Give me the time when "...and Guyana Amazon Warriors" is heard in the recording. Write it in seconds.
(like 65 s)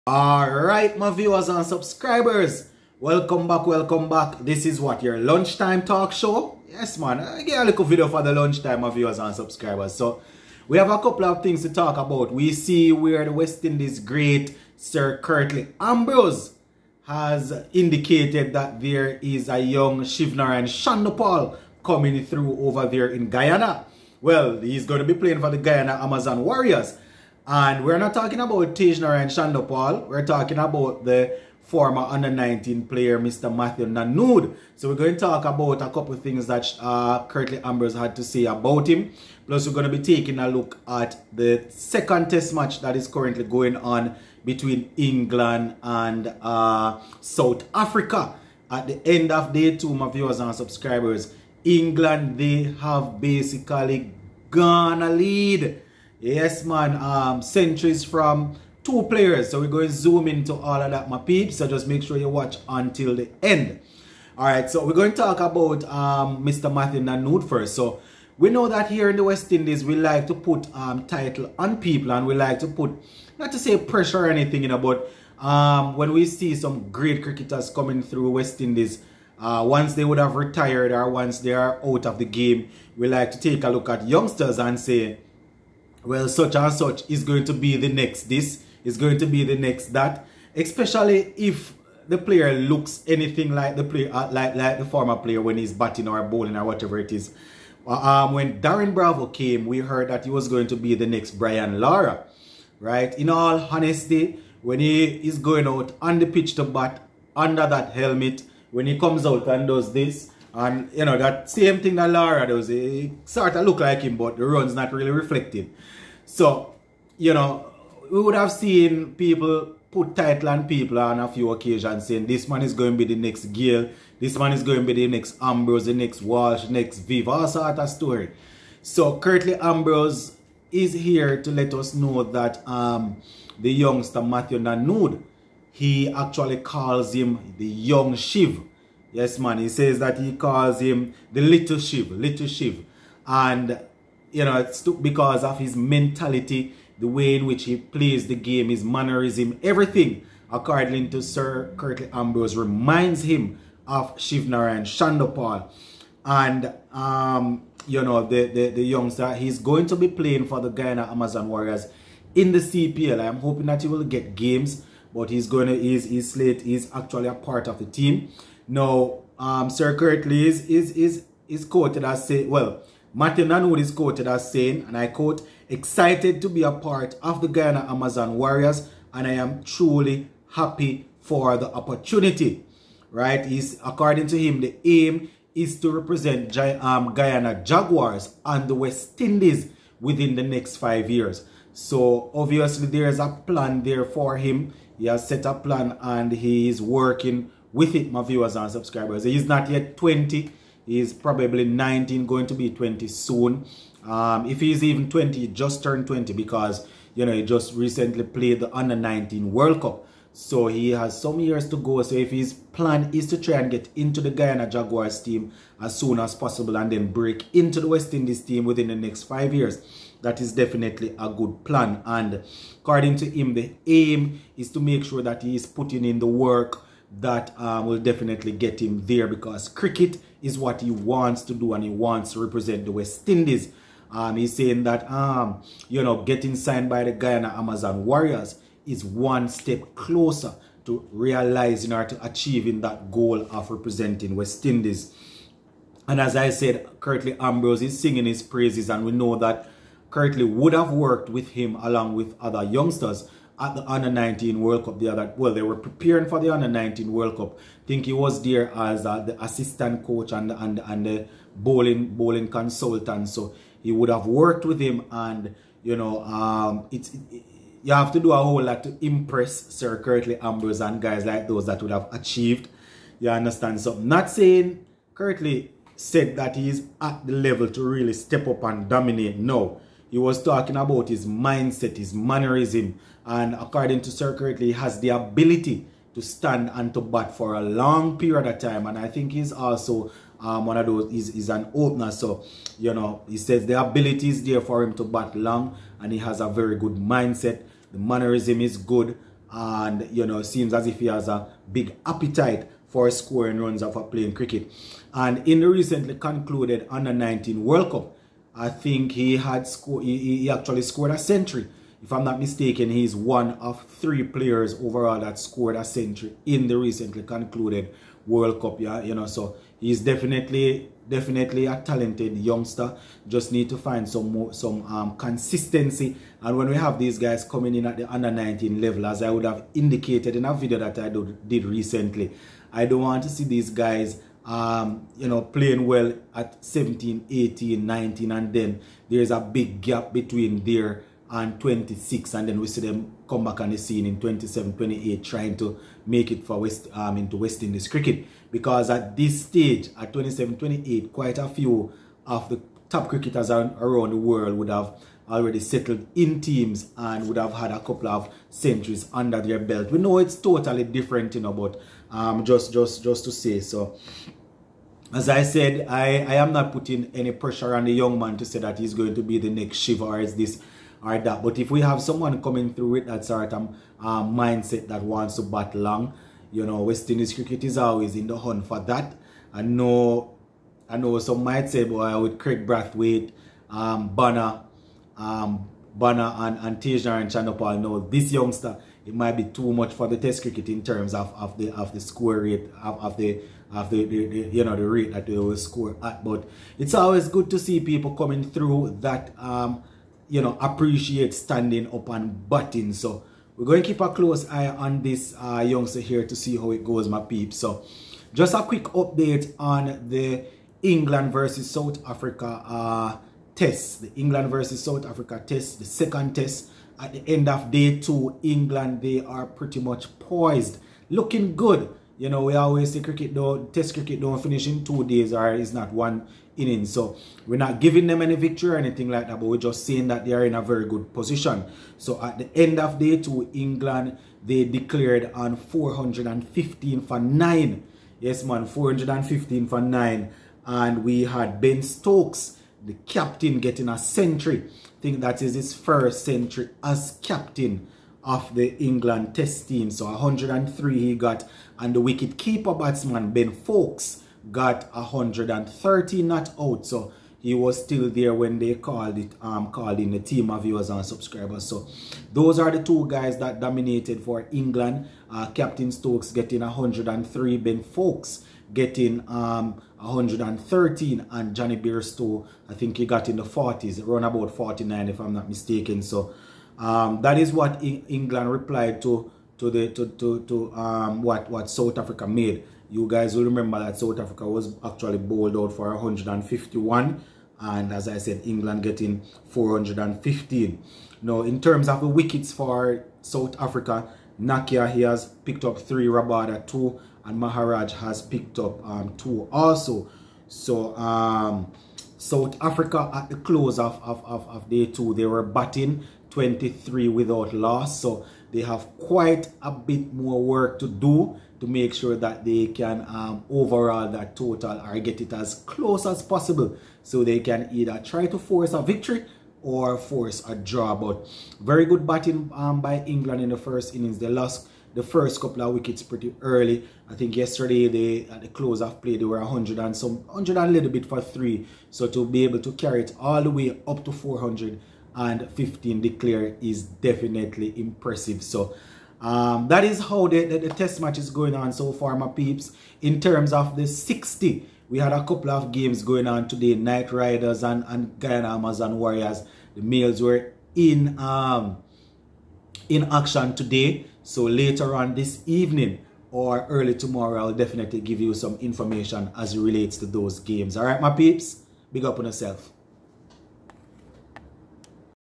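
547 s.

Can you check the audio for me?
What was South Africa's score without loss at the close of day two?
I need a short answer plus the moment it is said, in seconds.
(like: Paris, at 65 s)
23, at 506 s.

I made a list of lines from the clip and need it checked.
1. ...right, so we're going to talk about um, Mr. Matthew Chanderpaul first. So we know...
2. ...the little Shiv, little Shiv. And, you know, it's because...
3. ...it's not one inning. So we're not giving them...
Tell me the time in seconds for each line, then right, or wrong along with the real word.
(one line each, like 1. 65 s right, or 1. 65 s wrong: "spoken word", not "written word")
1. 64 s wrong: "Nandu", not "Chanderpaul"
2. 141 s right
3. 425 s right.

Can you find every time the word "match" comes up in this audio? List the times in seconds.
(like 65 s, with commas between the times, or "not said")
42 s, 540 s.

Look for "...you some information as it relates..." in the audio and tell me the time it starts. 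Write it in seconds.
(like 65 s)
558 s.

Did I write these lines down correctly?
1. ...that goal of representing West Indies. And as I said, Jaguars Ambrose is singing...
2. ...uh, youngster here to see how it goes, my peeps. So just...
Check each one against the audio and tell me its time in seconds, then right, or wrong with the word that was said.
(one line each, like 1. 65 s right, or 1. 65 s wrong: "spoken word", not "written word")
1. 242 s wrong: "Curtly", not "Jaguars"
2. 405 s right.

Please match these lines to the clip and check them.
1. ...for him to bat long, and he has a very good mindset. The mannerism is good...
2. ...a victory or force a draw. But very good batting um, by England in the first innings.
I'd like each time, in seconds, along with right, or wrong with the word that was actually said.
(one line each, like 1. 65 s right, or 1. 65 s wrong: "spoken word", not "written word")
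1. 294 s right
2. 518 s right.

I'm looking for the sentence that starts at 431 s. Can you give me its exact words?
So at the end of day two, England, they declared on 415 for nine.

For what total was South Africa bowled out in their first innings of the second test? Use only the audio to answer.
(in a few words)
151.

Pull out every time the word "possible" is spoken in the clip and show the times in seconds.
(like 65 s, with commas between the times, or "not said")
216 s, 516 s.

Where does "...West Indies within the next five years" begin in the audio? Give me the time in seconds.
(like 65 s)
188 s.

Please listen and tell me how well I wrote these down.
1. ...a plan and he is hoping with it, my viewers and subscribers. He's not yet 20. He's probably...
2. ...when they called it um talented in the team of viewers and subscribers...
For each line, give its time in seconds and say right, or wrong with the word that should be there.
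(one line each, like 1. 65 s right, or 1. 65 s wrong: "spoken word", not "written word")
1. 195 s wrong: "working", not "hoping"
2. 458 s wrong: "called", not "talented".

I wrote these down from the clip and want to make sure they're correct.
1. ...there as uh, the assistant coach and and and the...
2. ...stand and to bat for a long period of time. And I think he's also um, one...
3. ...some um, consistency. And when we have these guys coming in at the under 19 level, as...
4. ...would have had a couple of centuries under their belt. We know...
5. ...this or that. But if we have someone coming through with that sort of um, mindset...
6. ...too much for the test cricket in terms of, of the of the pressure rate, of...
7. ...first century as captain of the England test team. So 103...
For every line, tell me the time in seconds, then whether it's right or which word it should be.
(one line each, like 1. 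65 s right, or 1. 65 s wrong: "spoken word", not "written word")
1. 258 s right
2. 286 s right
3. 324 s right
4. 357 s right
5. 370 s right
6. 389 s wrong: "score", not "pressure"
7. 445 s right.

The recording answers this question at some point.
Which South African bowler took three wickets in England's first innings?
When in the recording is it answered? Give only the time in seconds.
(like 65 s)
494 s.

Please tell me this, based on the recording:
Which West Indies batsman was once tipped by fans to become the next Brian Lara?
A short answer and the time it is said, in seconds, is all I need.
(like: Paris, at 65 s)
Darren Bravo, at 98 s.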